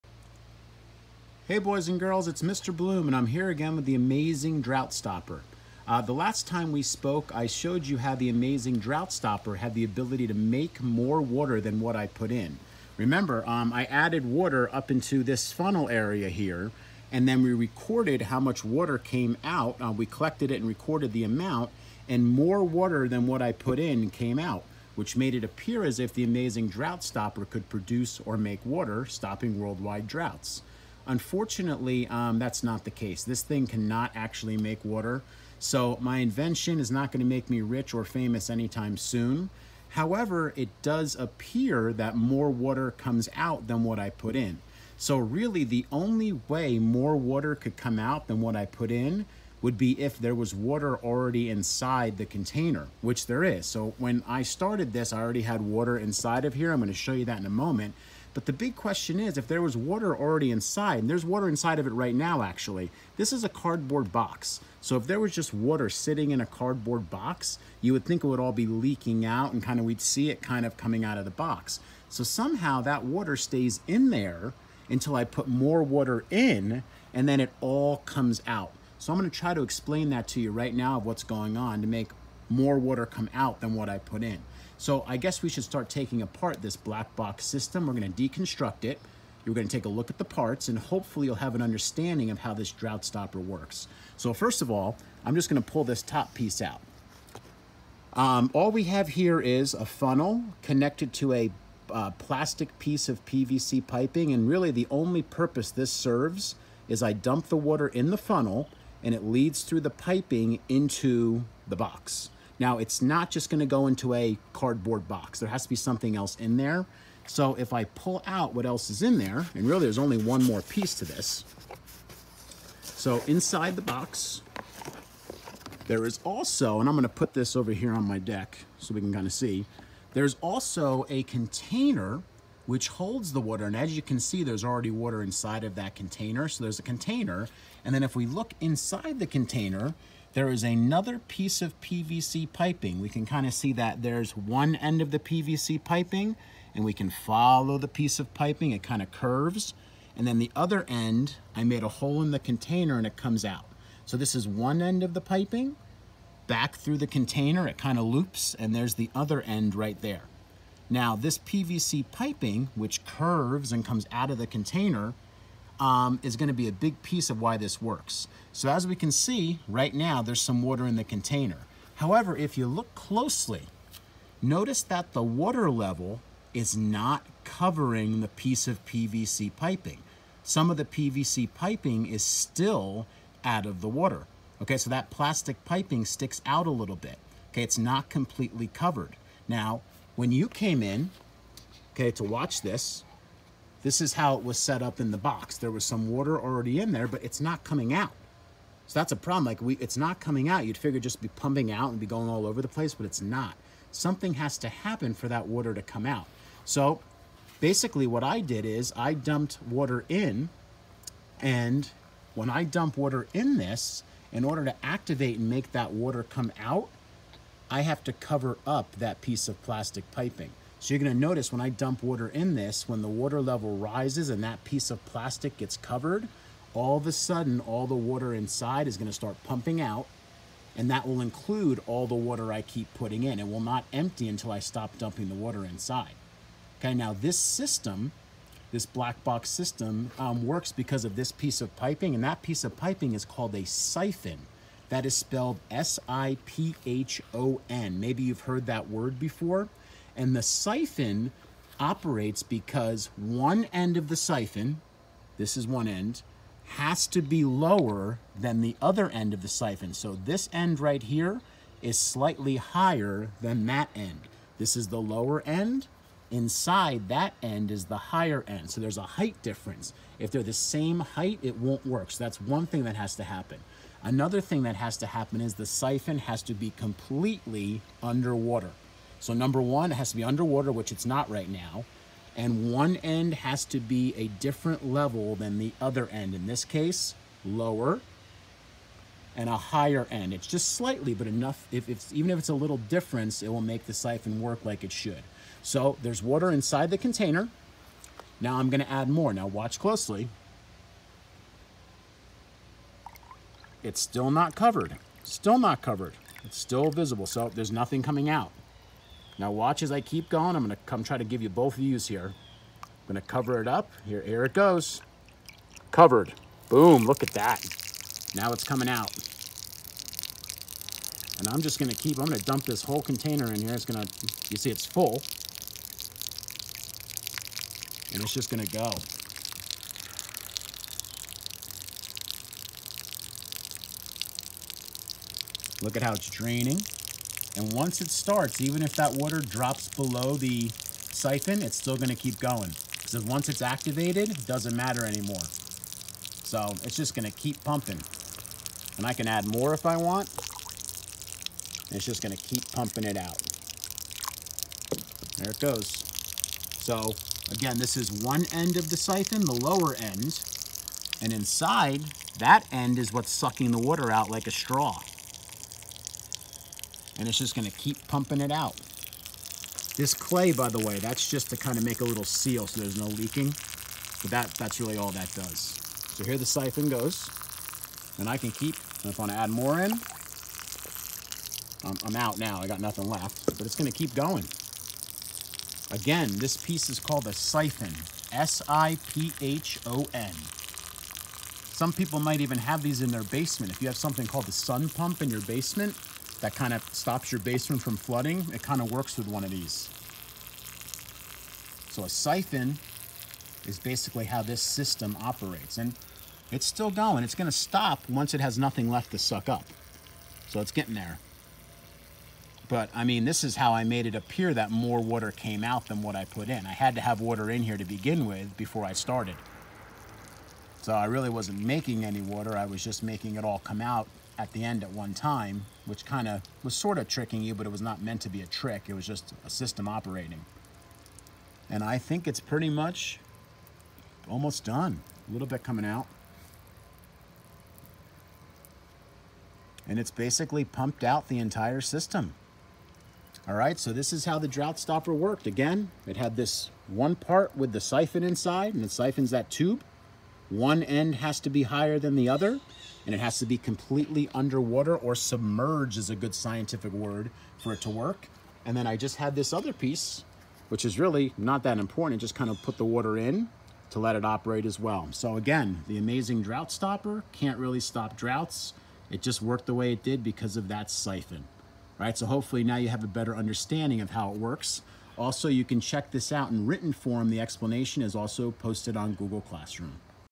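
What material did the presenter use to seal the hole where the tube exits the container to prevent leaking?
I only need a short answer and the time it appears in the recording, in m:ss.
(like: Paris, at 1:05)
Clay, at 6:09.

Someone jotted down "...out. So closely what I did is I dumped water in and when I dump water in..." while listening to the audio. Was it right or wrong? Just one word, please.
wrong.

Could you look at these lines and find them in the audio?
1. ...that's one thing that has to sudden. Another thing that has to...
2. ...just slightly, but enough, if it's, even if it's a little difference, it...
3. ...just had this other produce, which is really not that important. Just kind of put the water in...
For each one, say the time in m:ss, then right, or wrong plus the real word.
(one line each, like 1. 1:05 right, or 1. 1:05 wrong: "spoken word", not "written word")
1. 4:32 wrong: "happen", not "sudden"
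2. 4:50 right
3. 7:38 wrong: "piece", not "produce".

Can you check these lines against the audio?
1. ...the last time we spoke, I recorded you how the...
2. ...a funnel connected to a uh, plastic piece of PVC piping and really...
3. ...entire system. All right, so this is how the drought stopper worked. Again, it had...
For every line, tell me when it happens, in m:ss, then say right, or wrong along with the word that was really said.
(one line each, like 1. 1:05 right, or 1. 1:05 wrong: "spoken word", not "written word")
1. 0:05 wrong: "showed", not "recorded"
2. 1:39 right
3. 7:21 right.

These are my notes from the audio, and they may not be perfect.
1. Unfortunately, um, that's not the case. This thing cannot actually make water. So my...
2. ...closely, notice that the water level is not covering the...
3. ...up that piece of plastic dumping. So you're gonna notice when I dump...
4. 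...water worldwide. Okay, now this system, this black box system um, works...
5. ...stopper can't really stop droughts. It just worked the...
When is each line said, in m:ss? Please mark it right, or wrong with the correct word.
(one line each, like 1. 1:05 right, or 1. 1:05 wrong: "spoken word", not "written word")
1. 0:31 right
2. 2:52 right
3. 3:38 wrong: "piping", not "dumping"
4. 3:55 wrong: "inside", not "worldwide"
5. 7:46 right.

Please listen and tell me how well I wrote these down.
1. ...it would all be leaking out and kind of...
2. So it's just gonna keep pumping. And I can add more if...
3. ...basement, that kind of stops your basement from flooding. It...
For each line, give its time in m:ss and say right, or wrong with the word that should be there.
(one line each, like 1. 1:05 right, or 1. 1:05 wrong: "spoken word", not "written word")
1. 1:08 right
2. 5:46 right
3. 6:35 right.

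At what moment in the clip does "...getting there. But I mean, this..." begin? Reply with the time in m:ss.
6:50.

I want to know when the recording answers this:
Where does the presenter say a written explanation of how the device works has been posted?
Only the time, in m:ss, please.
7:59.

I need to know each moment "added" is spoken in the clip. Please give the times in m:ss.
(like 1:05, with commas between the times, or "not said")
0:13.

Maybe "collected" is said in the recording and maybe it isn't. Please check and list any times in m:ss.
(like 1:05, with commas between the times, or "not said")
0:20.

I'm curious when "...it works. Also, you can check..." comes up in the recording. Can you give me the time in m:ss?
7:54.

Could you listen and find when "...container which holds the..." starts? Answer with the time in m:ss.
2:11.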